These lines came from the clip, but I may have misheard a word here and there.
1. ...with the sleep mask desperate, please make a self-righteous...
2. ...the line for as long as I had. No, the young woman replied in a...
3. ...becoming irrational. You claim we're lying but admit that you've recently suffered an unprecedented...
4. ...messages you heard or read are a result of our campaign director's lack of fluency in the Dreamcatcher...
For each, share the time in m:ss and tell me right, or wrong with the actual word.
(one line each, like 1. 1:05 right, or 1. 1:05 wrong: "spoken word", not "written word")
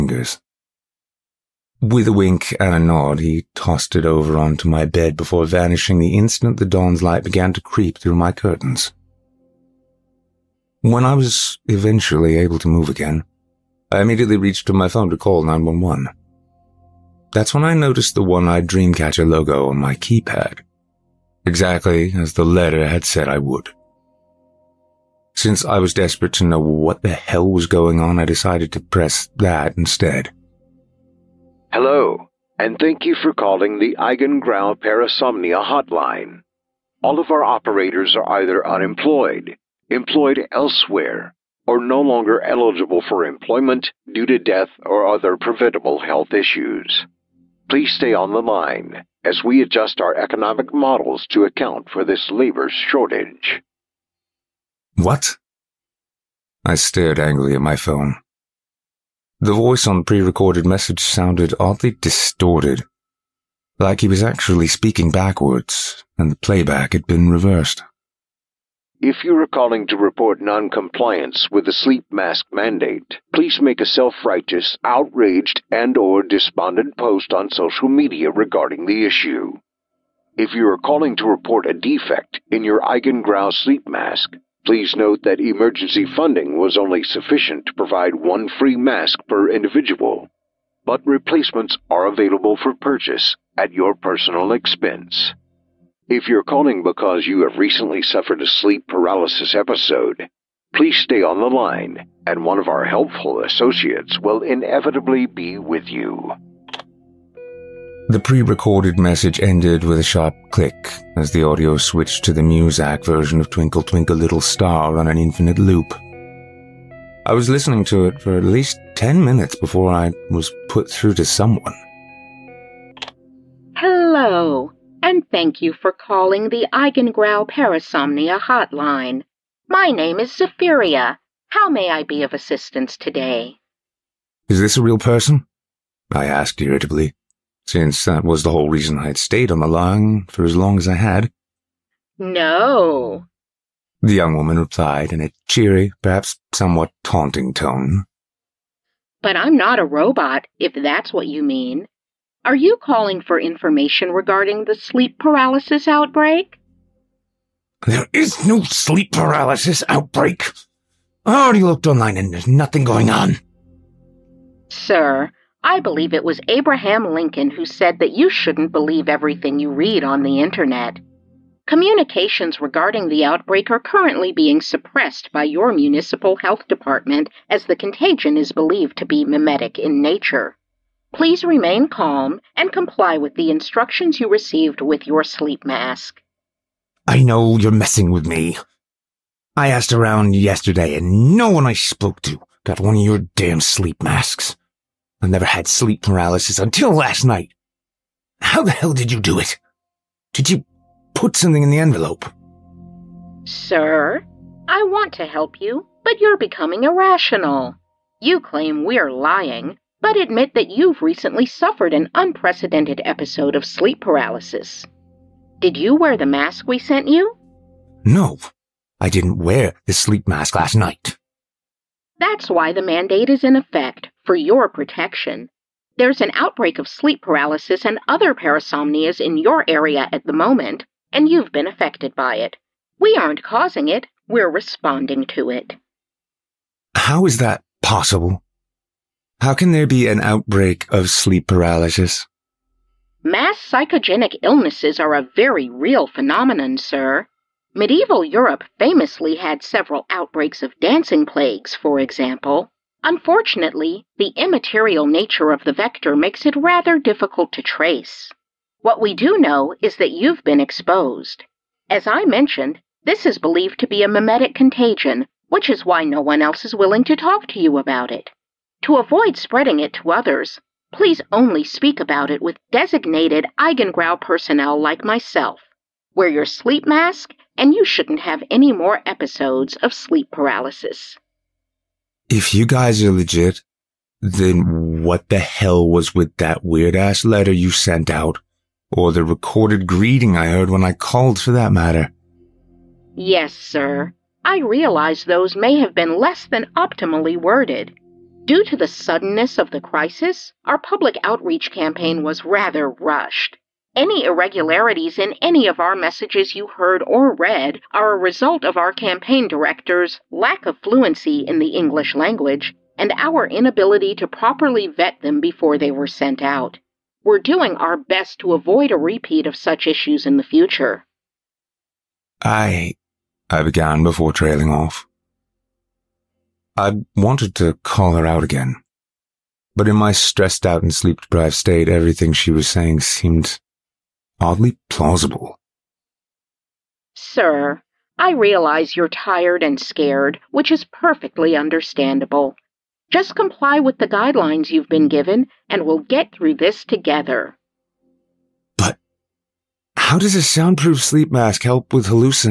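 1. 1:11 wrong: "mandate", not "desperate"
2. 2:19 right
3. 3:26 right
4. 5:05 wrong: "English", not "Dreamcatcher".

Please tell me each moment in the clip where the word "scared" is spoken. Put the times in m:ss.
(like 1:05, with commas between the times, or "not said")
5:39.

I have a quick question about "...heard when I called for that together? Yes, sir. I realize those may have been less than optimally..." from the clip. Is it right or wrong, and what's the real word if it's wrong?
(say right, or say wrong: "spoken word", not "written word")
wrong: "matter", not "together".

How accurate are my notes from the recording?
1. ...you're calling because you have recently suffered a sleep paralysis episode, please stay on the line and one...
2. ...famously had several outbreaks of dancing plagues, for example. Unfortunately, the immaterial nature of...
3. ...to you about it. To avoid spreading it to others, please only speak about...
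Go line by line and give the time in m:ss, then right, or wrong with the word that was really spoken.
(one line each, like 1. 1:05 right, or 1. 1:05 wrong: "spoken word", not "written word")
1. 1:36 right
2. 4:08 right
3. 4:27 right.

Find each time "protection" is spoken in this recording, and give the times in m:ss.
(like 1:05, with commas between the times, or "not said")
3:44.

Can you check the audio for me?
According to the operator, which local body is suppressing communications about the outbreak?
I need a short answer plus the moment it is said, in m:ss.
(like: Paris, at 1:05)
Municipal health department, at 2:55.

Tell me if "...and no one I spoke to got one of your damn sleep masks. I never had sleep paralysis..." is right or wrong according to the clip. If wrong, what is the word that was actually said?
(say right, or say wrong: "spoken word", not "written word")
right.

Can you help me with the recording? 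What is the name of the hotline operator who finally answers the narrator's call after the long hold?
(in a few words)
Zephyria.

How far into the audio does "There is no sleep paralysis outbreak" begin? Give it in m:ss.
2:37.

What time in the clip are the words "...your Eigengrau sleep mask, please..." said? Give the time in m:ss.
1:22.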